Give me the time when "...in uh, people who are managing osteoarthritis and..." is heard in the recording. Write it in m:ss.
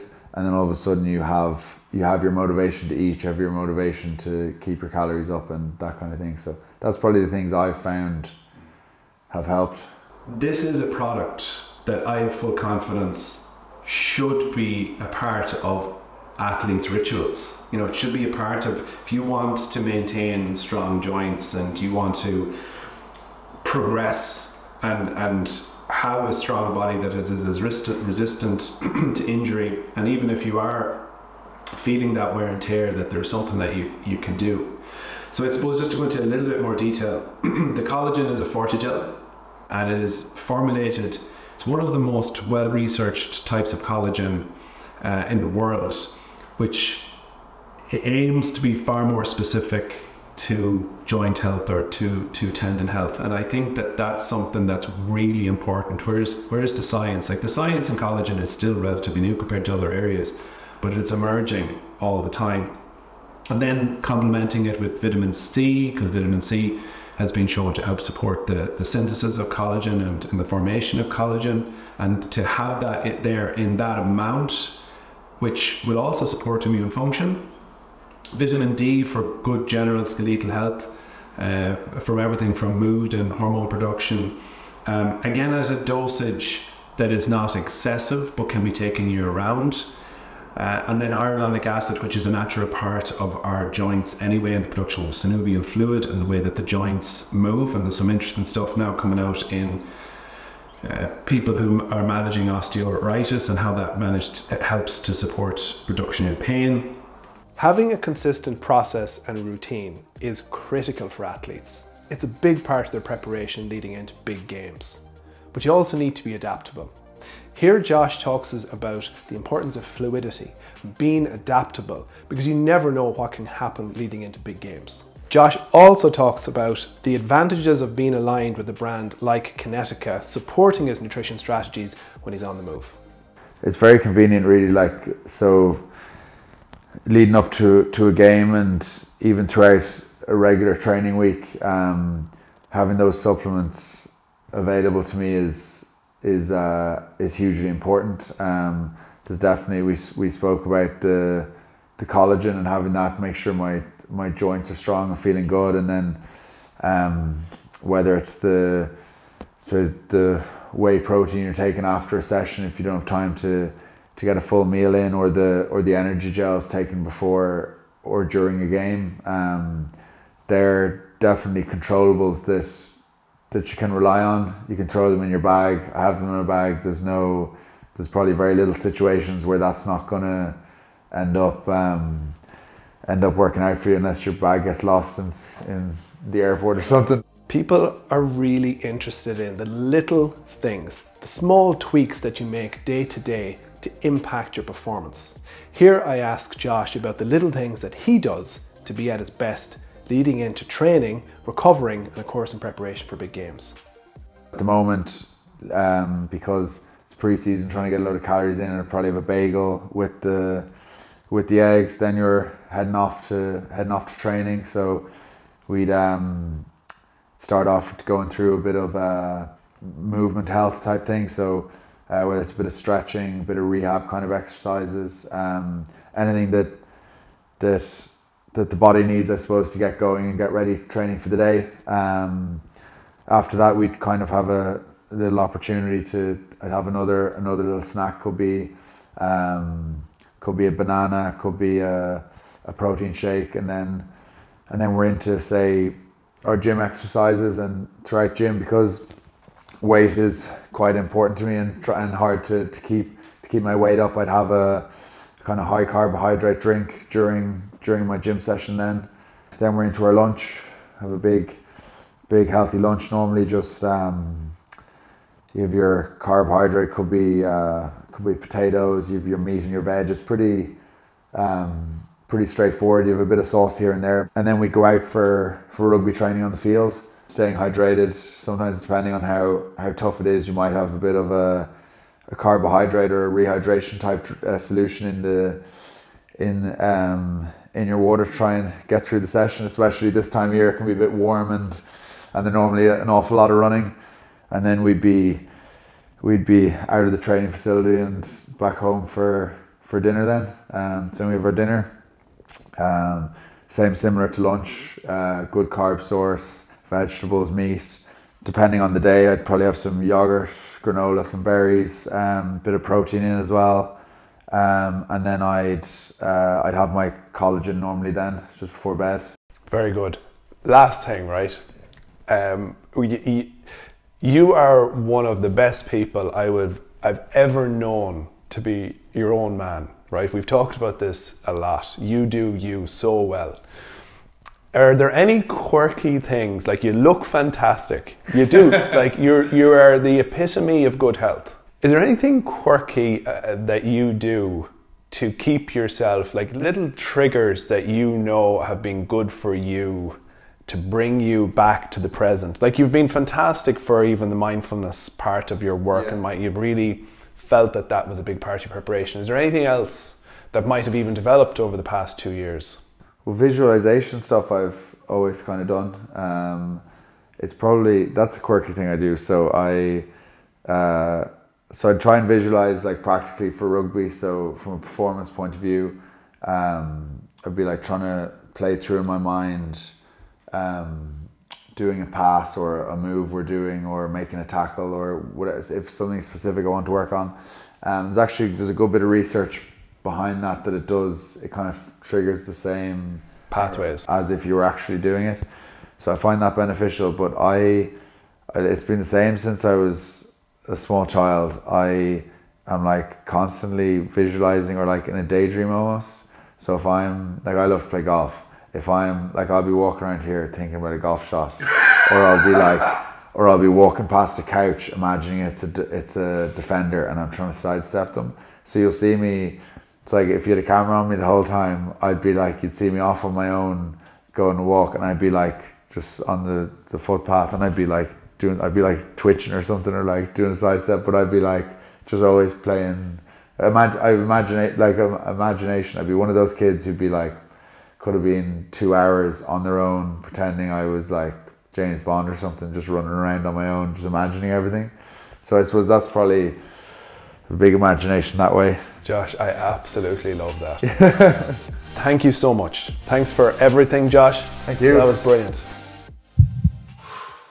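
1:39.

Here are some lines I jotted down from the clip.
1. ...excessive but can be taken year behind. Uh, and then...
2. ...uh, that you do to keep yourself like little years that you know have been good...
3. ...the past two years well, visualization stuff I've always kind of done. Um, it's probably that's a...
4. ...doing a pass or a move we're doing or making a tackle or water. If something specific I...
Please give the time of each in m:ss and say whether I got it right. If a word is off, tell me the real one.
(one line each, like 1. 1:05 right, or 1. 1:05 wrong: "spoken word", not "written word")
1. 1:27 wrong: "round", not "behind"
2. 5:43 wrong: "triggers", not "years"
3. 6:01 right
4. 6:21 wrong: "whatever", not "water".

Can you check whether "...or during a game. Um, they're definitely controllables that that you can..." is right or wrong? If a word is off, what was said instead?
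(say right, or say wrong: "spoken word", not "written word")
right.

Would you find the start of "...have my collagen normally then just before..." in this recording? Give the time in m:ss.
5:16.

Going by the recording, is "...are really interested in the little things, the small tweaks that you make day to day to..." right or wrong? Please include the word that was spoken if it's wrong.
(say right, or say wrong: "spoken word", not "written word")
right.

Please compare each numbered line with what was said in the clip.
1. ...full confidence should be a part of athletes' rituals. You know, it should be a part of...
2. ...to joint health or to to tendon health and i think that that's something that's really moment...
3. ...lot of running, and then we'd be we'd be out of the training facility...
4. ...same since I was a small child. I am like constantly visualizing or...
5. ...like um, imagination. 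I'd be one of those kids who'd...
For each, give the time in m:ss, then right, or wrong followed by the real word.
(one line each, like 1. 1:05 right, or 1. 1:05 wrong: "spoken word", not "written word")
1. 0:12 right
2. 0:50 wrong: "important", not "moment"
3. 4:53 right
4. 6:39 right
5. 7:14 right.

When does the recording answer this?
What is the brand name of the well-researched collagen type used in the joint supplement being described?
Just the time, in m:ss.
0:38.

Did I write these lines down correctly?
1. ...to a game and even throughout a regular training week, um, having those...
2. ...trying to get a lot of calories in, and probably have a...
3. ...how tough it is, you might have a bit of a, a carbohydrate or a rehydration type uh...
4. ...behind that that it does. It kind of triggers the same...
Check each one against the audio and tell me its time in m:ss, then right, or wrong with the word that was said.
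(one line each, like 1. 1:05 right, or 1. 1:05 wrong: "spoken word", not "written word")
1. 2:17 right
2. 3:27 right
3. 4:39 right
4. 6:30 right.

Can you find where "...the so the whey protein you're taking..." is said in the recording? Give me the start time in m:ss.
2:38.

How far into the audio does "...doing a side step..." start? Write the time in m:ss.
7:10.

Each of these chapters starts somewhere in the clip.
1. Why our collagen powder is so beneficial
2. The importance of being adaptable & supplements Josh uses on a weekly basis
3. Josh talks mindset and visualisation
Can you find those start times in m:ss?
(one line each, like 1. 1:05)
1. 0:09
2. 1:46
3. 5:18.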